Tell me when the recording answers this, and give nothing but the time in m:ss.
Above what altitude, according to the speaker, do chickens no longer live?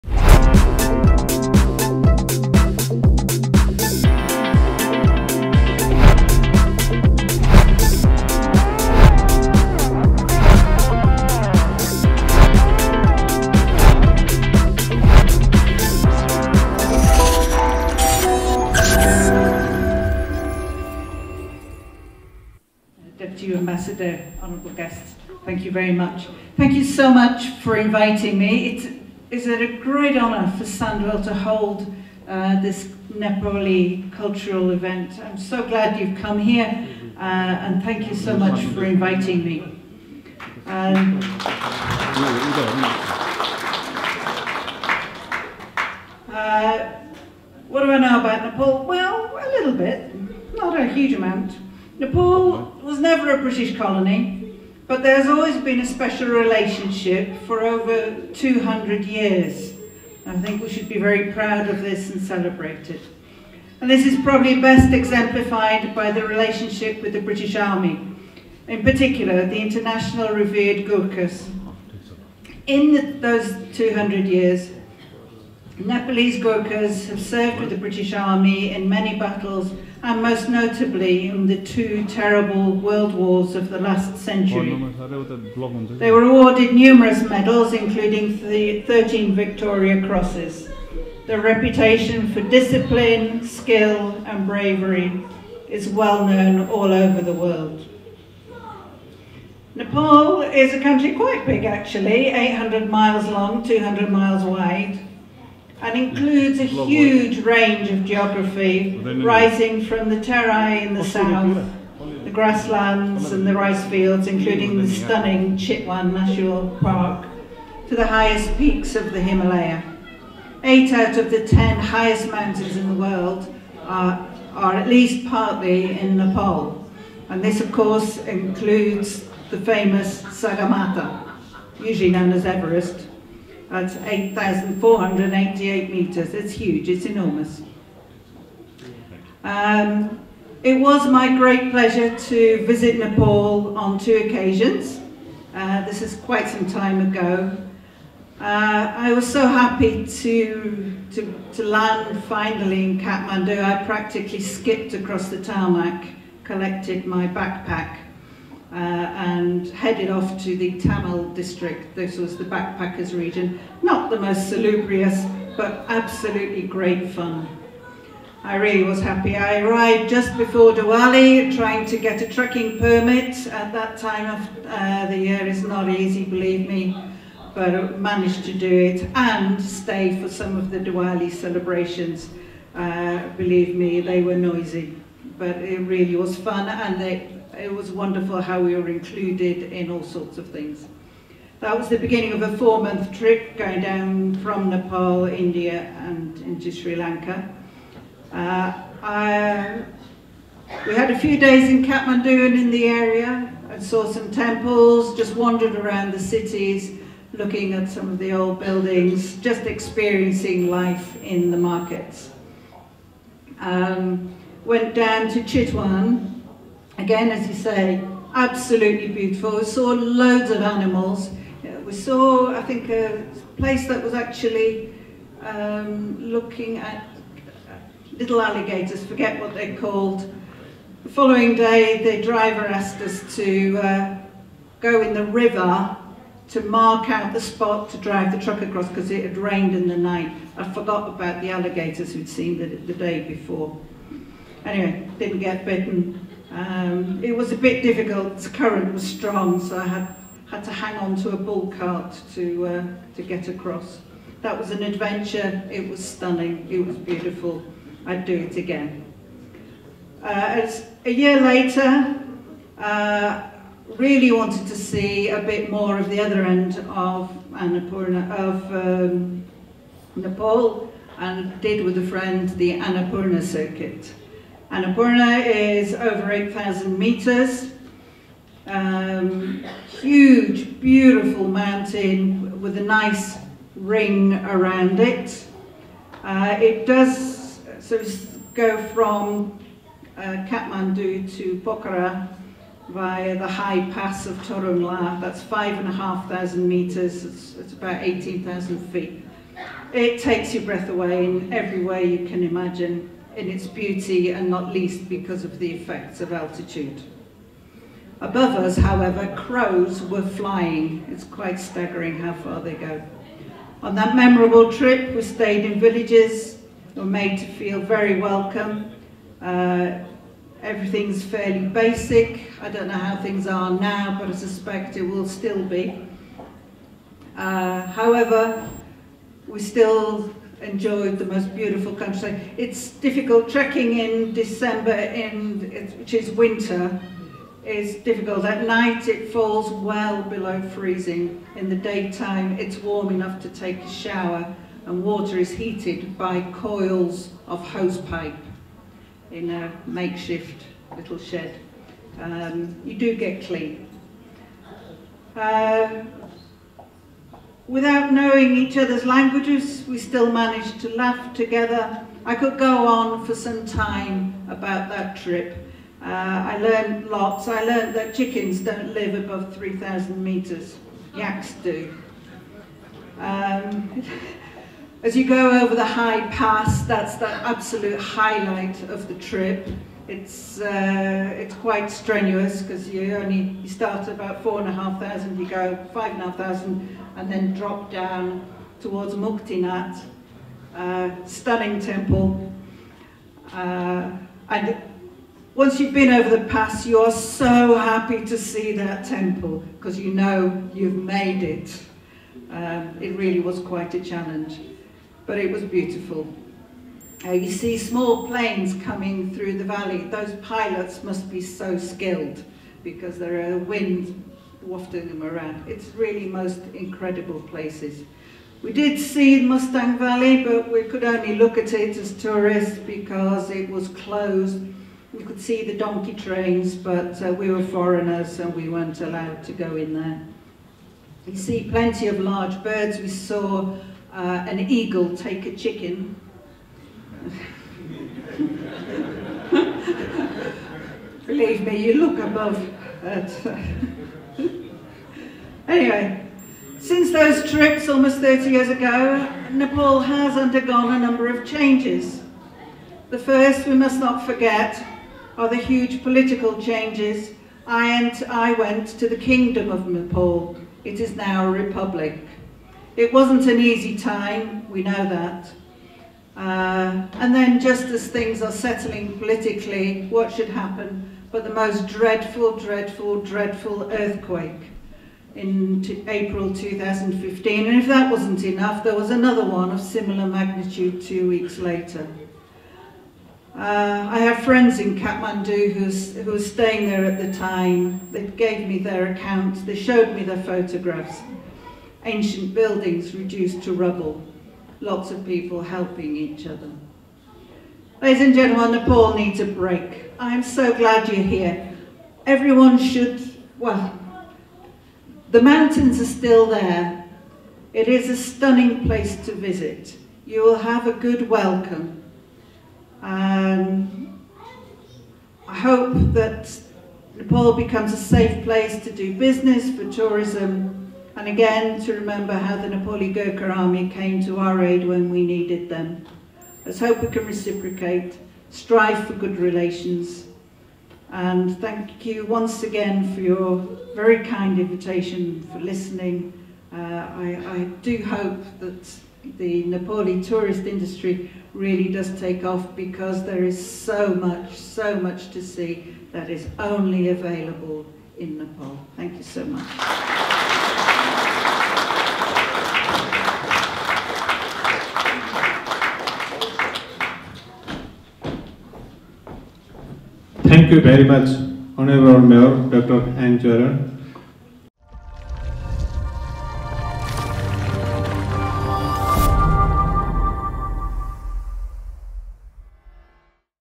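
6:09.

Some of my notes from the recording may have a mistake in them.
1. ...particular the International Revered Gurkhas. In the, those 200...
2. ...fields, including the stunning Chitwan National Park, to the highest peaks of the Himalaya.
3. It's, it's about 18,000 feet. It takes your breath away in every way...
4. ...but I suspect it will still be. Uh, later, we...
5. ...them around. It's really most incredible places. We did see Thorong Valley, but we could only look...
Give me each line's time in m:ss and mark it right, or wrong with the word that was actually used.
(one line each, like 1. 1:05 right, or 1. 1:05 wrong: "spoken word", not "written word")
1. 1:08 right
2. 1:53 right
3. 4:57 right
4. 5:24 wrong: "however", not "later"
5. 6:55 wrong: "Mustang", not "Thorong".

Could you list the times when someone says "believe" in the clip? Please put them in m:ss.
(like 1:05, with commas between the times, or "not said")
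2:56, 3:03, 7:21.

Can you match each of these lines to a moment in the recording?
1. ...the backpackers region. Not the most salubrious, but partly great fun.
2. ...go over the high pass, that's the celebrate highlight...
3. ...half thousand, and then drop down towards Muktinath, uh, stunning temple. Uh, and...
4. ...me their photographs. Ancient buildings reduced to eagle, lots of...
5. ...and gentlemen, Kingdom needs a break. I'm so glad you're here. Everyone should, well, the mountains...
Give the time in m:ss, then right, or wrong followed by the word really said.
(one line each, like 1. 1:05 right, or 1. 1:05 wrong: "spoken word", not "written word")
1. 2:42 wrong: "absolutely", not "partly"
2. 6:15 wrong: "absolute", not "celebrate"
3. 6:26 right
4. 8:10 wrong: "rubble", not "eagle"
5. 8:18 wrong: "Nepal", not "Kingdom".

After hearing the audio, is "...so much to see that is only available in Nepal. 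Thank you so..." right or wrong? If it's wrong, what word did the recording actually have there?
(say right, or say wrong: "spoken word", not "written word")
right.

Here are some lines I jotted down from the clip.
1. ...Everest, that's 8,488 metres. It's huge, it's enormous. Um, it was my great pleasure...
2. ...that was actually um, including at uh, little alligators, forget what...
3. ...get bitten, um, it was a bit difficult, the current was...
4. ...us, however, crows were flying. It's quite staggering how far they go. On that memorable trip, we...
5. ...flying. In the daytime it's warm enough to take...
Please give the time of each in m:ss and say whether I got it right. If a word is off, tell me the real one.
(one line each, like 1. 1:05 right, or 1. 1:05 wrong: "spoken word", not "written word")
1. 2:12 right
2. 3:43 wrong: "looking", not "including"
3. 4:05 right
4. 5:08 right
5. 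5:40 wrong: "freezing", not "flying".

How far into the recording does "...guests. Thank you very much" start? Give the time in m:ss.
0:24.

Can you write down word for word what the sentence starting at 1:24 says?
Oh, they were awarded numerous medals, including the 13 Victoria Crosses.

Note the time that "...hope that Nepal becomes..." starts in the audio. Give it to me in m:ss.
8:35.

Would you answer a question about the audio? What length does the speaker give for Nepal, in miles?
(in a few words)
800 miles.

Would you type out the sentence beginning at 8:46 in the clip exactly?
Let's hope we can reciprocate, strive for good relations, and thank you once again for your very kind invitation, for listening.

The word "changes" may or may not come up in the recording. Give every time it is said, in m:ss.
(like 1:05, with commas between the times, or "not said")
7:31, 7:36.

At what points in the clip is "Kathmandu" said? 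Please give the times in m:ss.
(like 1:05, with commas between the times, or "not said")
2:32, 3:21, 4:50, 8:04.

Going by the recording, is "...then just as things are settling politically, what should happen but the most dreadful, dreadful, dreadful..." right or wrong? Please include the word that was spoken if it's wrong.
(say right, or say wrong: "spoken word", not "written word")
right.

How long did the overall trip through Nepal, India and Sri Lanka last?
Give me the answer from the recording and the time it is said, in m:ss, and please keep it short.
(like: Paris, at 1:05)
4 months, at 3:12.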